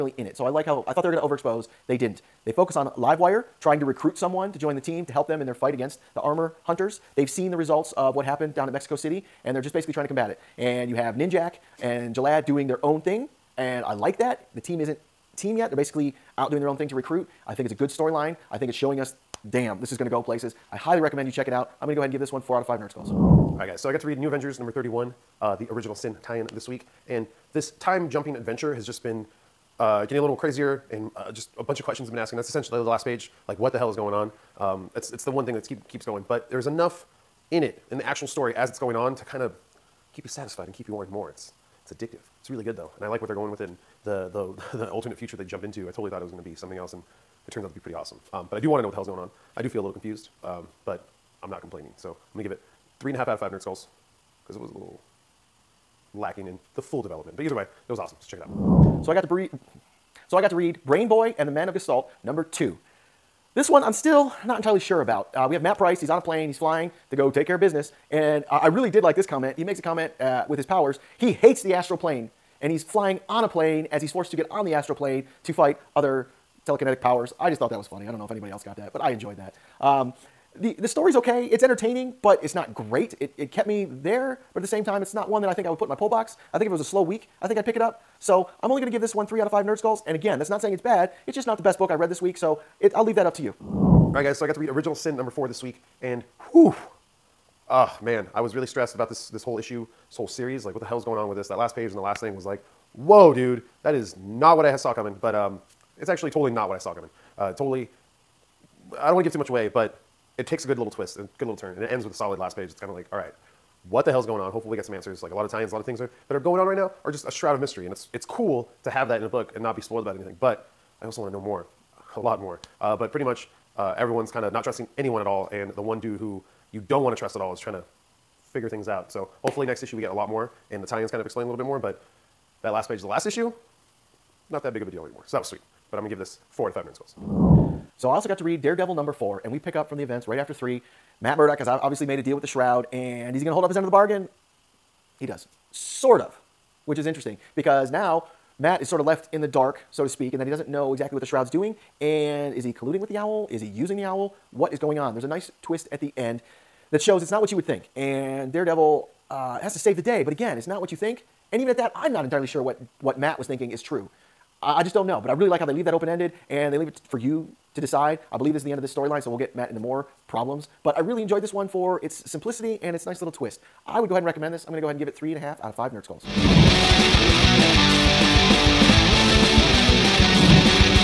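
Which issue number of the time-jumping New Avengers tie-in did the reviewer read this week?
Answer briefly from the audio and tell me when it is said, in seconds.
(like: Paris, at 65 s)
31, at 24 s.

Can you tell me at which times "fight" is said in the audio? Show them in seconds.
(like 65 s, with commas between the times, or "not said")
5 s, 75 s.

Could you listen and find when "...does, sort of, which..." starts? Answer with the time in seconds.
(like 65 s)
145 s.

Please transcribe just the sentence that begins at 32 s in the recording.
That's essentially the last page like what the hell is going on?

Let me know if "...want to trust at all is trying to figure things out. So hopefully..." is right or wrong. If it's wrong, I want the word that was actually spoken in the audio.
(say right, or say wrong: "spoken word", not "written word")
right.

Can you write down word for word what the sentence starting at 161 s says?
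And even at that, I'm not entirely sure what, what Matt was thinking is true.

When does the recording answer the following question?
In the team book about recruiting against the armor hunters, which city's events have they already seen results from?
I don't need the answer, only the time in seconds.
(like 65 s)
8 s.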